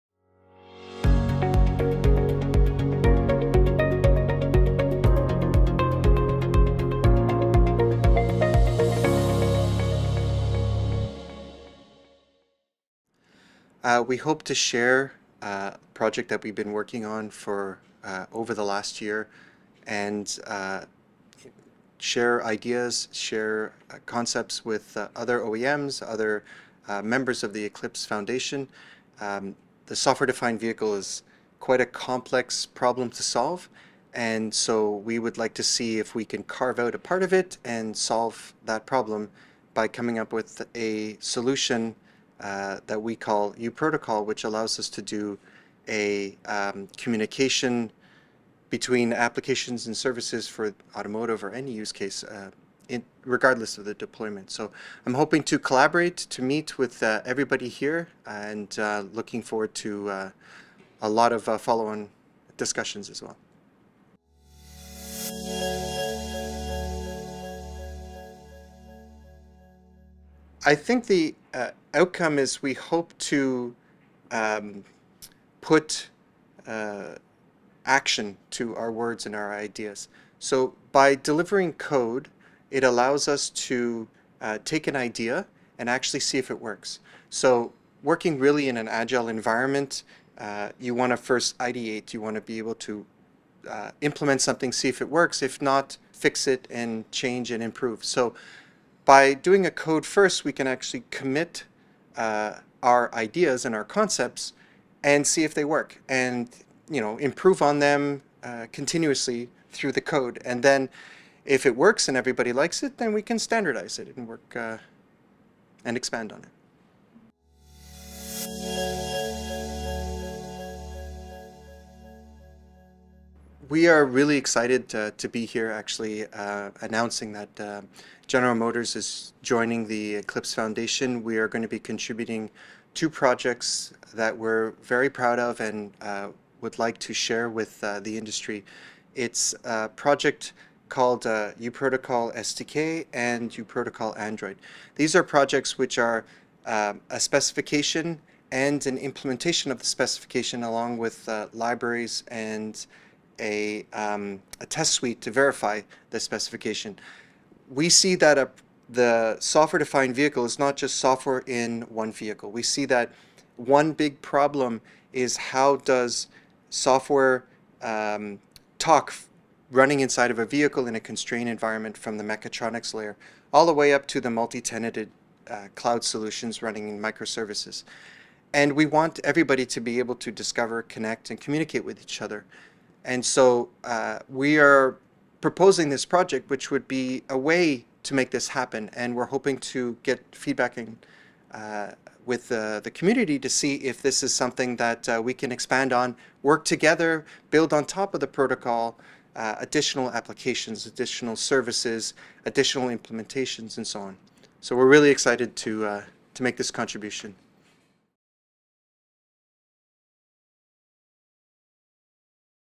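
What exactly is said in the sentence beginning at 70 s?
I think the uh, outcome is we hope to um, put uh, action to our words and our ideas.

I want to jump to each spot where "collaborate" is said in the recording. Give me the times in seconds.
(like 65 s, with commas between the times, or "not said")
55 s.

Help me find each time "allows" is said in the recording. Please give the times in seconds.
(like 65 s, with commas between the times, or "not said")
44 s, 82 s.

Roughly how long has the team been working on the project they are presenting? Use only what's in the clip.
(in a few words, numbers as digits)
over the last year.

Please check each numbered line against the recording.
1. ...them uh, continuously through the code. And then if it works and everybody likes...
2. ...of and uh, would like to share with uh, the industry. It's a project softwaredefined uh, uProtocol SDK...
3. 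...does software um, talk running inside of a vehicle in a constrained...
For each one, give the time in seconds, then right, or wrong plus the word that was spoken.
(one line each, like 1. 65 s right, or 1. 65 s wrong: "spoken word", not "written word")
1. 107 s right
2. 135 s wrong: "called", not "softwaredefined"
3. 165 s right.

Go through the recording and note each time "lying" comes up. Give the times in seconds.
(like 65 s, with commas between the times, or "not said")
not said.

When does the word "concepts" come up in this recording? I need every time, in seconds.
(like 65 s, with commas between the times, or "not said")
24 s, 103 s.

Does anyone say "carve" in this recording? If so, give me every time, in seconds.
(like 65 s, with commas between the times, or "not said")
36 s.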